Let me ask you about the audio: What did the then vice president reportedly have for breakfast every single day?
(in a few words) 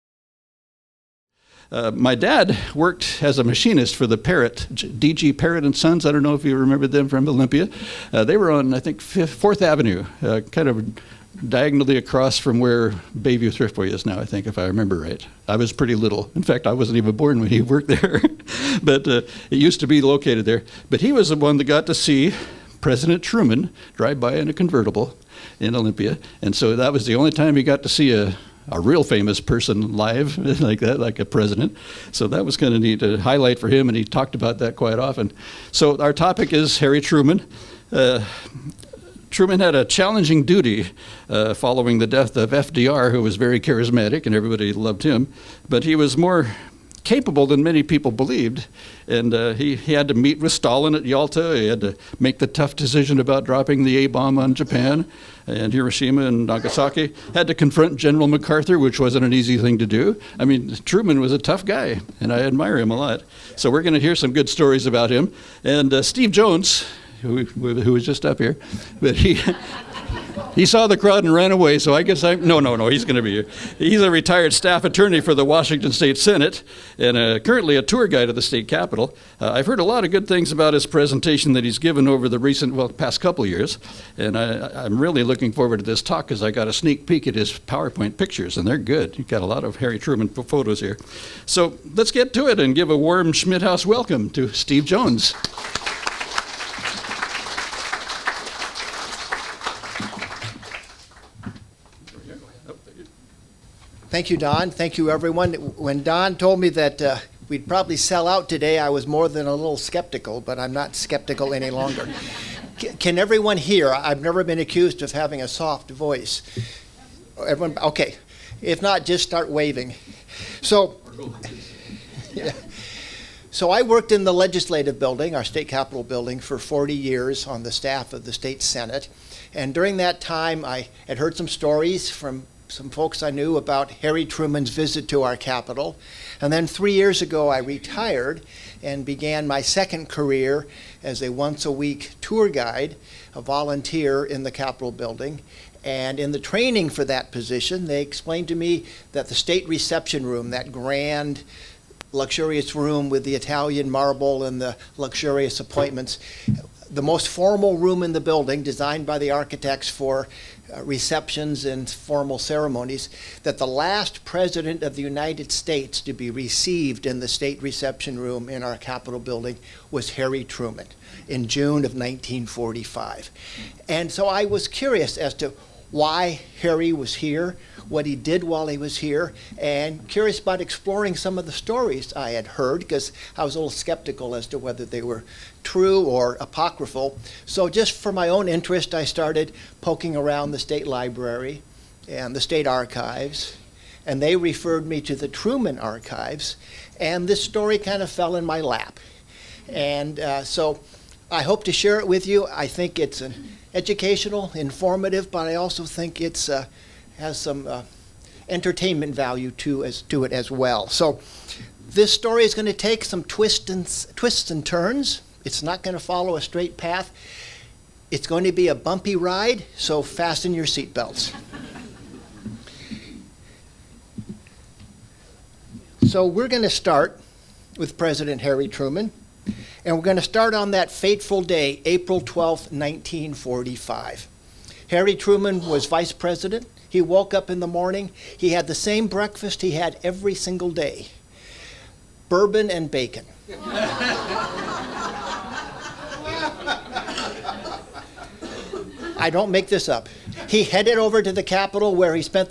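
Bourbon and bacon.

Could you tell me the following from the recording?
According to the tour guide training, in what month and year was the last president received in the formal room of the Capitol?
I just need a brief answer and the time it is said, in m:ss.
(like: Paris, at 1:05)
June 1945, at 2:51.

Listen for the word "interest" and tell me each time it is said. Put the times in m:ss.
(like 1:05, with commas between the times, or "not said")
3:08.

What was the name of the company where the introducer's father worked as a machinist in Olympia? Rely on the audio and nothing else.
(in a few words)
DG Parrot and Sons.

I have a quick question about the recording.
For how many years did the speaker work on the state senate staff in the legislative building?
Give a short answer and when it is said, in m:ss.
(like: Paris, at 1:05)
40, at 2:06.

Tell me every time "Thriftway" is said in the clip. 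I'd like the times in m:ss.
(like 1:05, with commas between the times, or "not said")
0:13.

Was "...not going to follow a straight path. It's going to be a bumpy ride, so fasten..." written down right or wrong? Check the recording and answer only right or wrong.
right.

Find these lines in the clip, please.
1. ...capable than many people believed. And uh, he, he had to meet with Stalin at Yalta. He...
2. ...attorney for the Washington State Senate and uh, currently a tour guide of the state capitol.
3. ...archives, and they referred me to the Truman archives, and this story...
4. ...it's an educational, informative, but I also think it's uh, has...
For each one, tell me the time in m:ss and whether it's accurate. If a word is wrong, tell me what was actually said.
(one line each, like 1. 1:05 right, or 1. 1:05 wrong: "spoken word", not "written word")
1. 0:47 right
2. 1:14 right
3. 3:12 right
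4. 3:22 right.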